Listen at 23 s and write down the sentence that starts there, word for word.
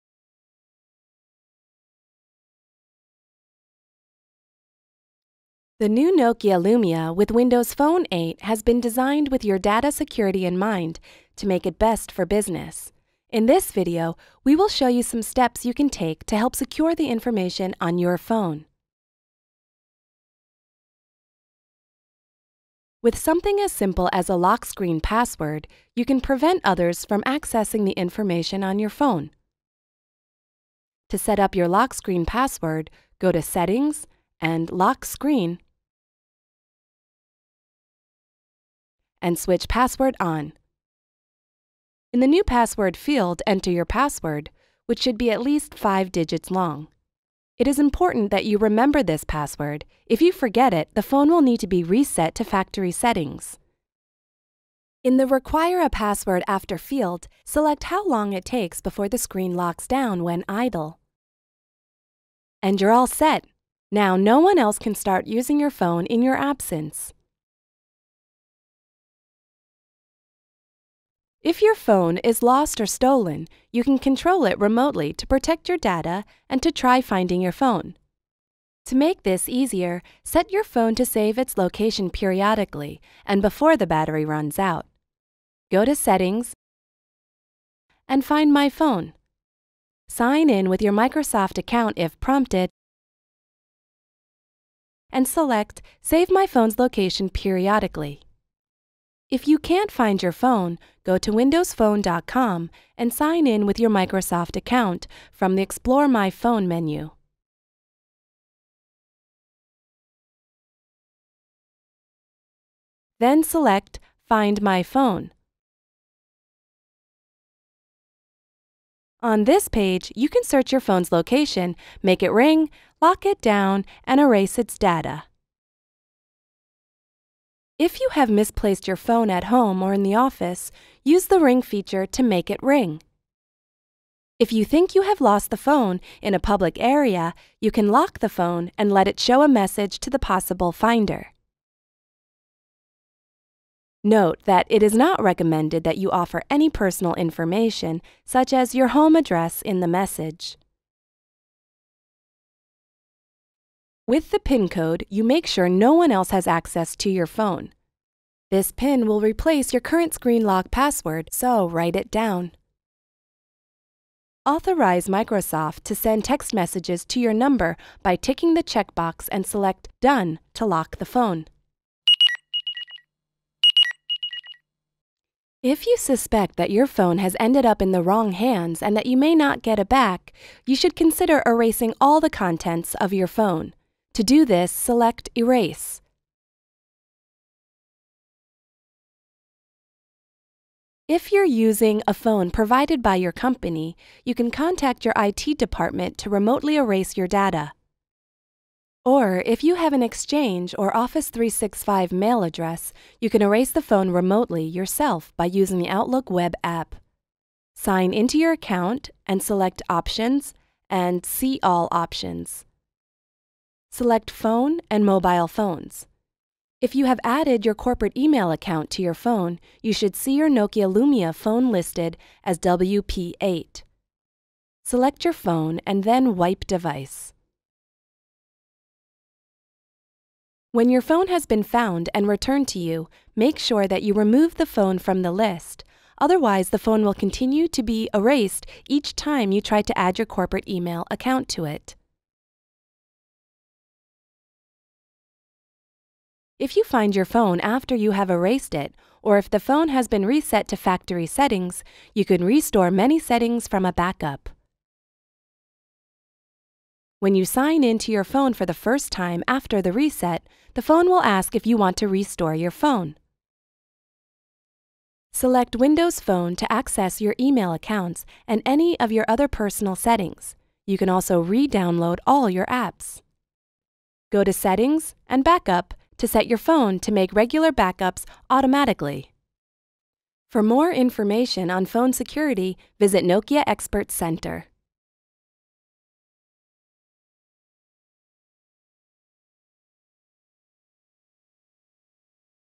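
With something as simple as a lock screen password, you can prevent others from accessing the information on your phone.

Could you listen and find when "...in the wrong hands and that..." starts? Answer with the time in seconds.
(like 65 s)
177 s.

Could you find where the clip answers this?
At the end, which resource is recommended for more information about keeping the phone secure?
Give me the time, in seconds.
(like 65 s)
283 s.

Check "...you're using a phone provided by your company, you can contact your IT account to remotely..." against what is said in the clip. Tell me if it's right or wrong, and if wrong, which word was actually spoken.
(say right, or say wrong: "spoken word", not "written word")
wrong: "department", not "account".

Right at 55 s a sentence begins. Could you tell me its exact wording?
In the Require a Password After field, select how long it takes before the screen locks down when idle.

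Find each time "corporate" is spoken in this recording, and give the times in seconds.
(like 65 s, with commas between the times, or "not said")
217 s, 240 s.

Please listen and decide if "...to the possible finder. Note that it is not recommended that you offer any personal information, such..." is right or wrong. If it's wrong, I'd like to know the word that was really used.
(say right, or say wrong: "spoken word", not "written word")
right.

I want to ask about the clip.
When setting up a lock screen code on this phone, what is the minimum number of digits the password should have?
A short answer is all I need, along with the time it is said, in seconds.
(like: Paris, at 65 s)
5, at 45 s.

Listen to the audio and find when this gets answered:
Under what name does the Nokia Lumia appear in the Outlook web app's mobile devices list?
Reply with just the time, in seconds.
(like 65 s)
222 s.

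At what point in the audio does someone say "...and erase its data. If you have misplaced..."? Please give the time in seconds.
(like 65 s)
124 s.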